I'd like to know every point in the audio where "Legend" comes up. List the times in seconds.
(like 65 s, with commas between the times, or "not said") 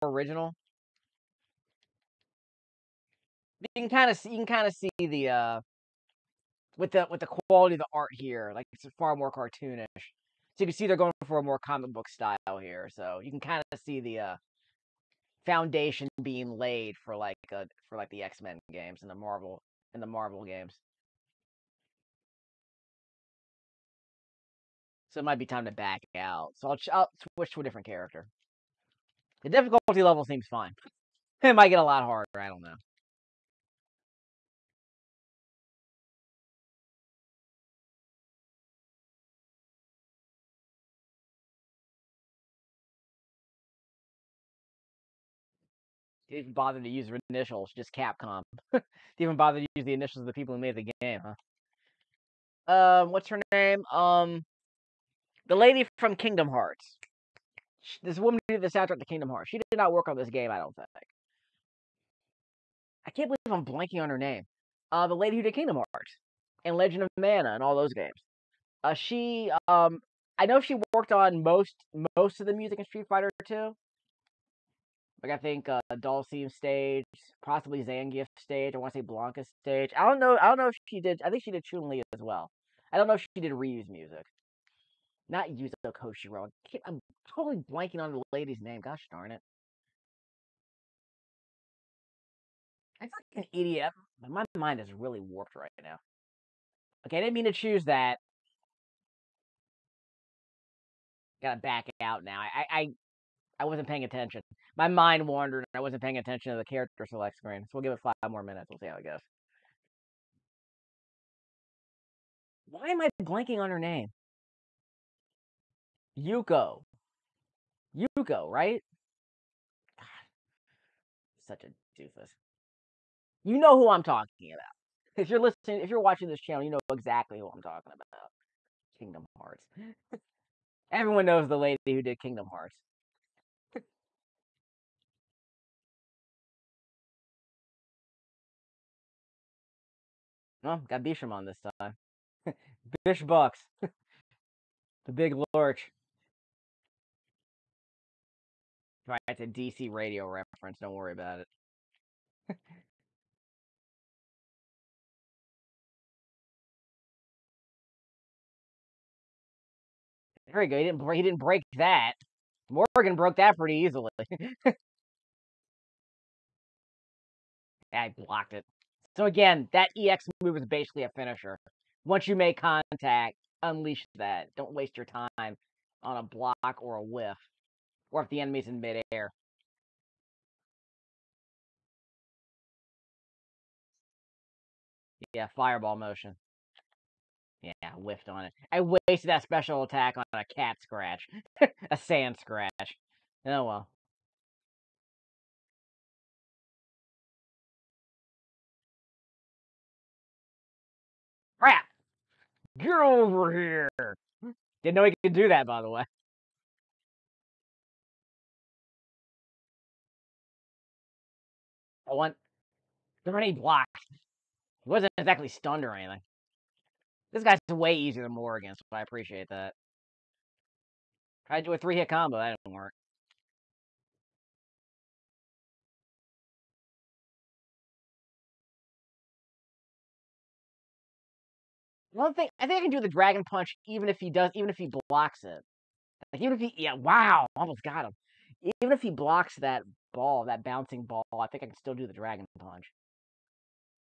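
66 s.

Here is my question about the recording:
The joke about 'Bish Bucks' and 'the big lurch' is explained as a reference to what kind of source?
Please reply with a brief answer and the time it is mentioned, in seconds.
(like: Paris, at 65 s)
DC radio, at 149 s.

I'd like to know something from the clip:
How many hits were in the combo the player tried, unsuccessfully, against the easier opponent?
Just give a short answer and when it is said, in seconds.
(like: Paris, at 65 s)
3, at 221 s.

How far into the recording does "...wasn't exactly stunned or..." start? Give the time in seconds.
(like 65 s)
214 s.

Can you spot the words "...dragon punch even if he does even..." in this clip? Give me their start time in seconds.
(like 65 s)
233 s.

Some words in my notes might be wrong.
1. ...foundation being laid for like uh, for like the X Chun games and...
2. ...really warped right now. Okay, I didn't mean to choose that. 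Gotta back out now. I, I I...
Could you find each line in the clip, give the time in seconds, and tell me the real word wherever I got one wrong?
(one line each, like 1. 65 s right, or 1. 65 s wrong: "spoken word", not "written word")
1. 15 s wrong: "Men", not "Chun"
2. 94 s right.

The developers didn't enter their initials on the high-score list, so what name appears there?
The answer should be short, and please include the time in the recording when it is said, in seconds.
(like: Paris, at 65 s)
Capcom, at 47 s.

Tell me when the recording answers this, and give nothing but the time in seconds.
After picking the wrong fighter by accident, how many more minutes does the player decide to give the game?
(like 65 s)
108 s.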